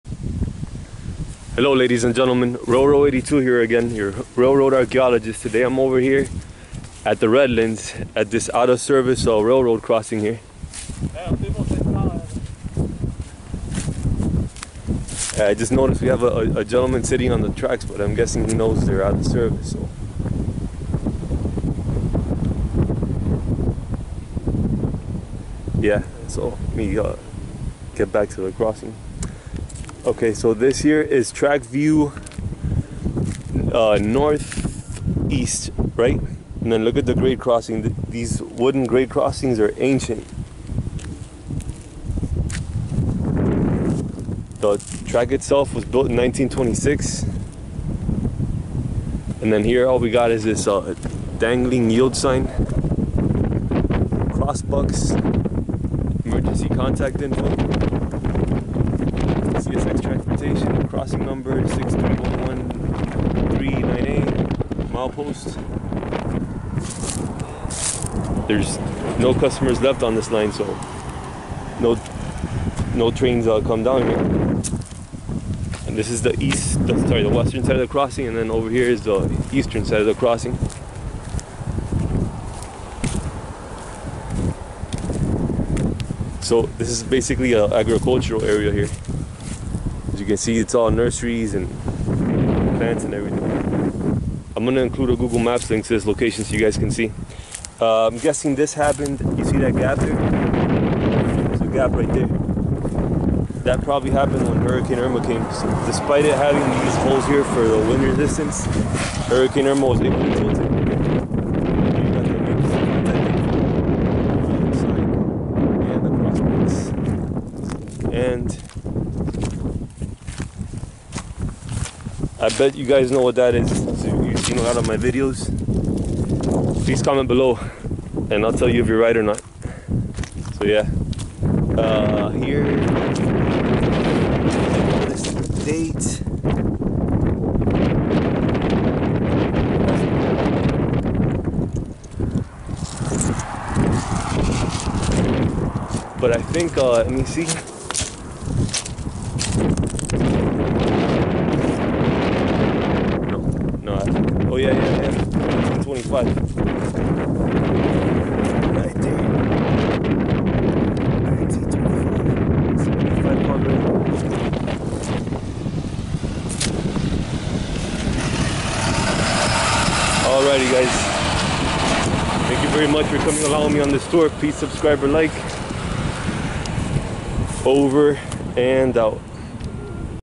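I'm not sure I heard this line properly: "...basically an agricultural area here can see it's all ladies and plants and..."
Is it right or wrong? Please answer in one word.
wrong.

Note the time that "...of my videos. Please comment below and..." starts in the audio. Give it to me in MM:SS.
02:04.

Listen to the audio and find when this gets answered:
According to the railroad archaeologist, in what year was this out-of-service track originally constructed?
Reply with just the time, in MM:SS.
00:46.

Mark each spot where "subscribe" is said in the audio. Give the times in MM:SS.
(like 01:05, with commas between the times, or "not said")
02:54.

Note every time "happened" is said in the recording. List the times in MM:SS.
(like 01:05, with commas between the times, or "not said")
01:38, 01:44.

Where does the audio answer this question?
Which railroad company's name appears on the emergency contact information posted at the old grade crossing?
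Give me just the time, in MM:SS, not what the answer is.
00:59.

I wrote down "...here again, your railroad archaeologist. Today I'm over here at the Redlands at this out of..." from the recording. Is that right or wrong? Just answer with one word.
right.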